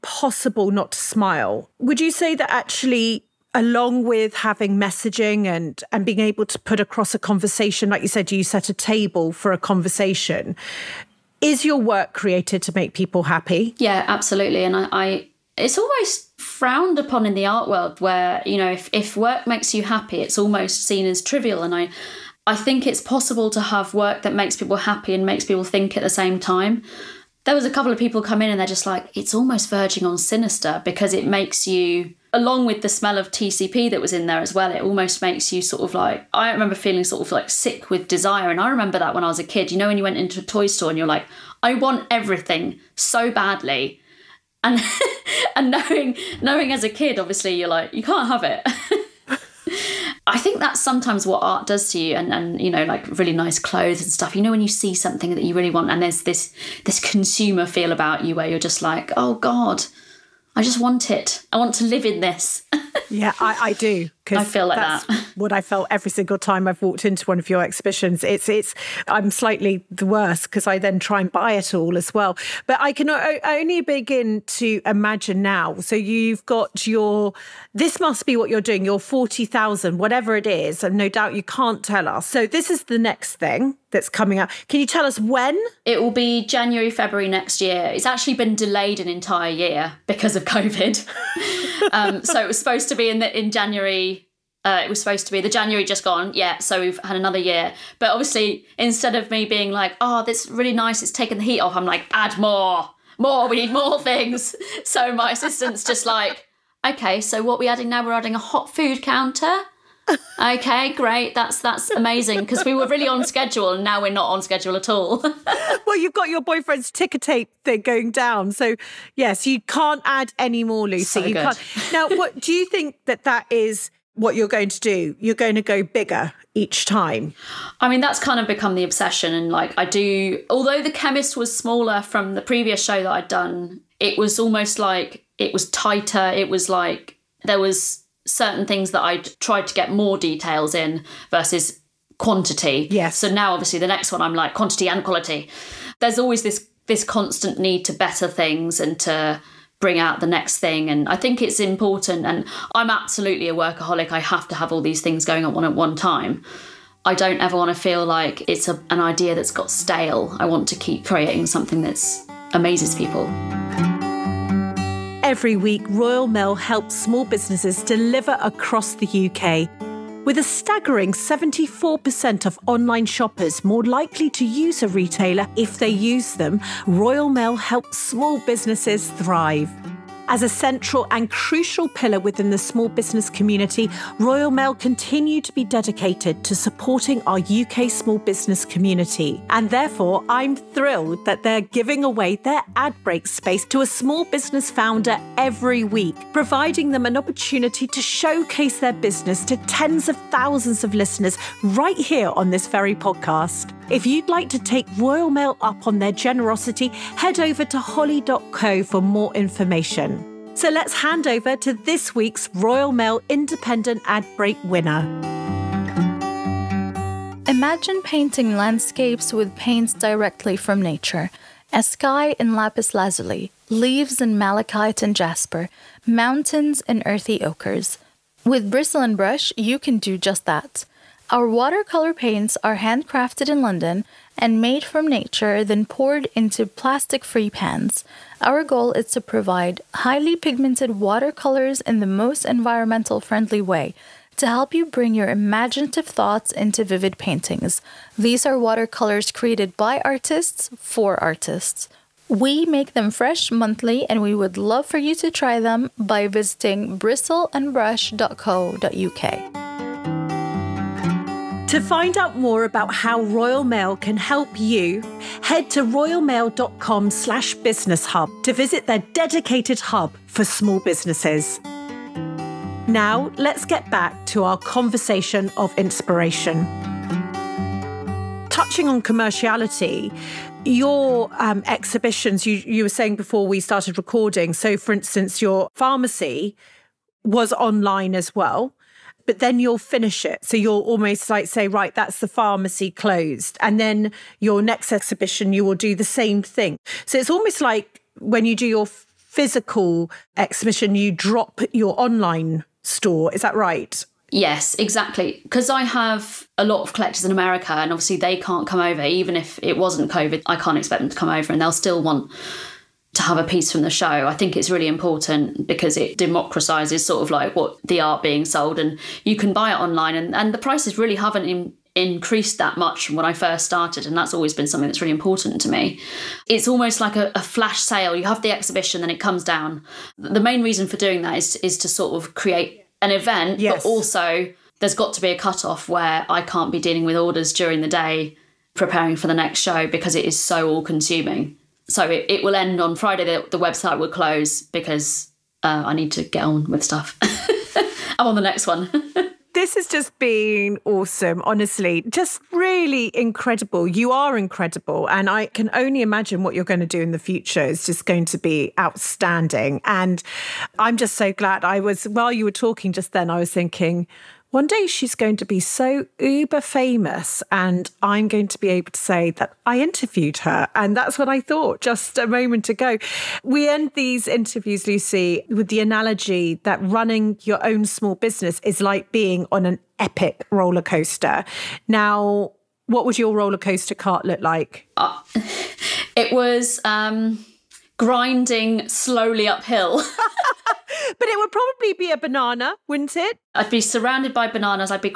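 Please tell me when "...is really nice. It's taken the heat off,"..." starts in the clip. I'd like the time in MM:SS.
01:40.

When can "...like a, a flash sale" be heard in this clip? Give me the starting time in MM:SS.
05:27.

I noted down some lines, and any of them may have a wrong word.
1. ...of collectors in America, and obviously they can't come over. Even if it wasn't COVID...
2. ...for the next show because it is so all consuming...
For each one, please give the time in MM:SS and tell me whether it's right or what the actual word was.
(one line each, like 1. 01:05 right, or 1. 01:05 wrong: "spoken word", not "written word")
1. 05:06 right
2. 05:39 right.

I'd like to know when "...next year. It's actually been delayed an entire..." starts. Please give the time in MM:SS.
01:27.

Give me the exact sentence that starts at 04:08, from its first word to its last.
These are watercolors created by artists for artists.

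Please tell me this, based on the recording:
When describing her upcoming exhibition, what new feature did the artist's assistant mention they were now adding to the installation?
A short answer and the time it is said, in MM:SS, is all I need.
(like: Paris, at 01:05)
hot food counter, at 01:48.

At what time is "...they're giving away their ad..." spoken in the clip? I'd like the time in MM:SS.
03:11.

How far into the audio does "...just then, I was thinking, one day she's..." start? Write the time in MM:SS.
06:02.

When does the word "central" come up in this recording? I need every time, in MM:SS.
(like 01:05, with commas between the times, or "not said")
03:00.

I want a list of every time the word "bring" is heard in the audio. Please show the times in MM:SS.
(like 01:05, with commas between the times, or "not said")
02:29, 04:04.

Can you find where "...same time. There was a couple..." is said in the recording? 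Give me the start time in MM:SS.
00:26.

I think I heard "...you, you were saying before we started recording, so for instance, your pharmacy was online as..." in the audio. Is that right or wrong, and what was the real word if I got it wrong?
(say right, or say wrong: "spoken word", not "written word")
right.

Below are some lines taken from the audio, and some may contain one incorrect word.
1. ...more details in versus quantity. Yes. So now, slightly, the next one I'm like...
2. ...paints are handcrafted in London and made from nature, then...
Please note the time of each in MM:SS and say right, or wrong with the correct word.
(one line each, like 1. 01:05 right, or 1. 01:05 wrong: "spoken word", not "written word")
1. 02:19 wrong: "obviously", not "slightly"
2. 03:52 right.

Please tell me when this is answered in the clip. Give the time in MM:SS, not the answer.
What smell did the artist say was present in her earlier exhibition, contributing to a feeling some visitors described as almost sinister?
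00:33.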